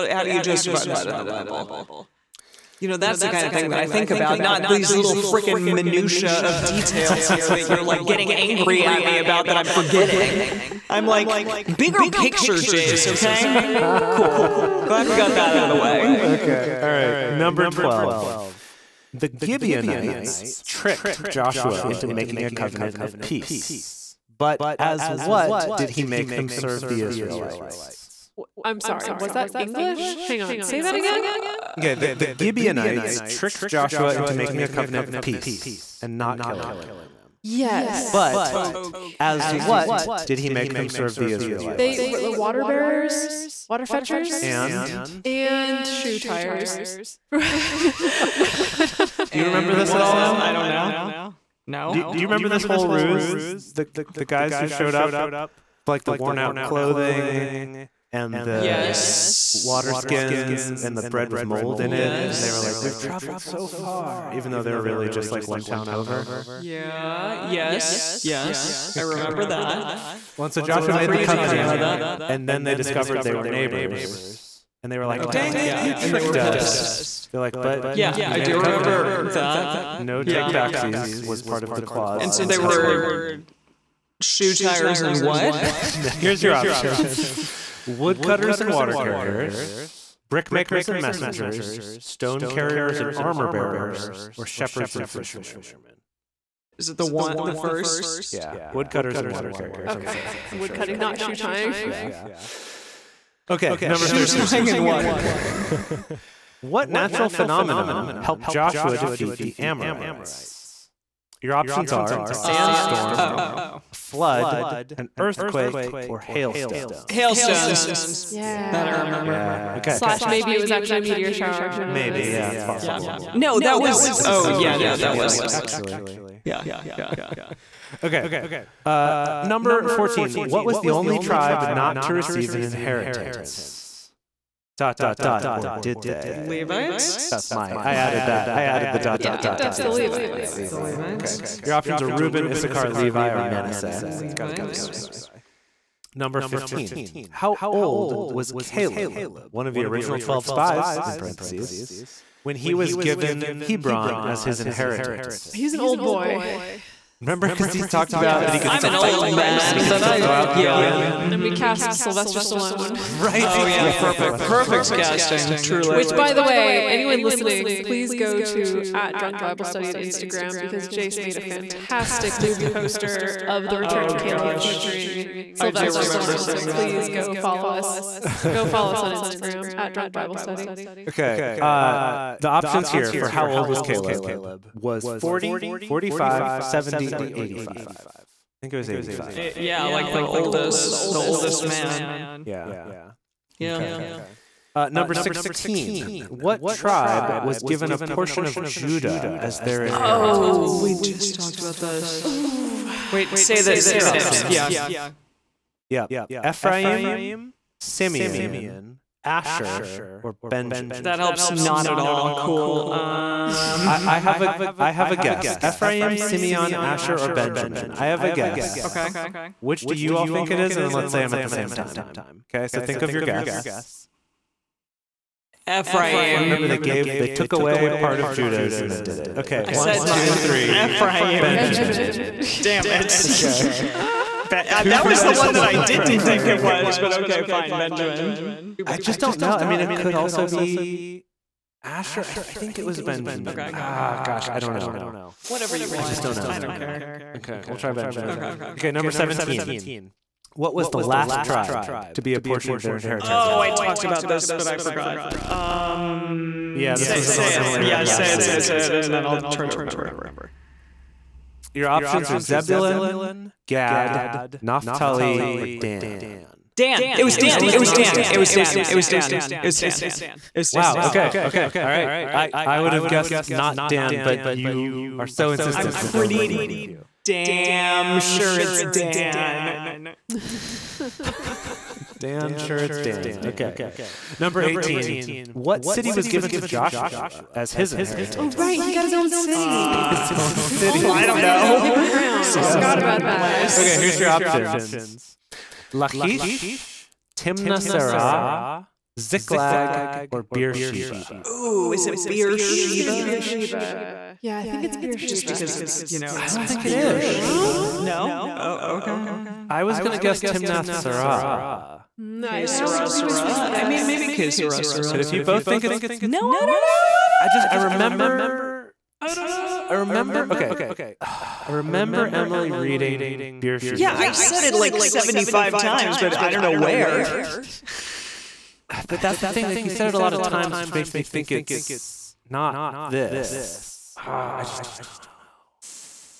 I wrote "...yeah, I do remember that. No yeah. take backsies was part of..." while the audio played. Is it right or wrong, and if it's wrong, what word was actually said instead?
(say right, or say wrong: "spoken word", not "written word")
right.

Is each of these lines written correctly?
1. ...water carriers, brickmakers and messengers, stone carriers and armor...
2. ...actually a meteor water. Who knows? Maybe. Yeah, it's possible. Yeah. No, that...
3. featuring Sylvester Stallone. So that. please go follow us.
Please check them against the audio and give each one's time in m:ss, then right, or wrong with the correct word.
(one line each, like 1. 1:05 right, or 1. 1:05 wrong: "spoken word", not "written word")
1. 1:28 right
2. 2:00 wrong: "shower", not "water"
3. 2:54 right.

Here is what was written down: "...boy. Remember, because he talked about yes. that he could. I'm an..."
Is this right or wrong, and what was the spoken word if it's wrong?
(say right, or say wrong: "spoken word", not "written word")
right.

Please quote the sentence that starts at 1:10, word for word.
Well, so Joshua made the covenant.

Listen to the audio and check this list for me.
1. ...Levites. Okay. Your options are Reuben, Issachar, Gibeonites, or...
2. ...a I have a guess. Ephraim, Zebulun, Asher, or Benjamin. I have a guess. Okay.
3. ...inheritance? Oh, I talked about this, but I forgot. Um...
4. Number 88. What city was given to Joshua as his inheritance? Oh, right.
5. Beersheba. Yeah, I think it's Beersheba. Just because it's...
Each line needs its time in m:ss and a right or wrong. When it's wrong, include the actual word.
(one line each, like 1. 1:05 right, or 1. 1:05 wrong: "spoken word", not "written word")
1. 2:20 wrong: "Levi", not "Gibeonites"
2. 3:34 wrong: "Simeon", not "Zebulun"
3. 4:12 right
4. 4:44 wrong: "18", not "88"
5. 5:03 right.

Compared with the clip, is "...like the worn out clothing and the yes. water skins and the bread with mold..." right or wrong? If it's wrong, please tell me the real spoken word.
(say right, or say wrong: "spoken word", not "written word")
right.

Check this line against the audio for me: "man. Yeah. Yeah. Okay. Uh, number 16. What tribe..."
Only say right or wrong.
right.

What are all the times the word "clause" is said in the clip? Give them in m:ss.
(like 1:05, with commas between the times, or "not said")
1:21.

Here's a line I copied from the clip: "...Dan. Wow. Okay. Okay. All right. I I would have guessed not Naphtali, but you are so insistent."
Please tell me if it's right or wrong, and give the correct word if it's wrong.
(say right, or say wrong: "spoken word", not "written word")
wrong: "Dan", not "Naphtali".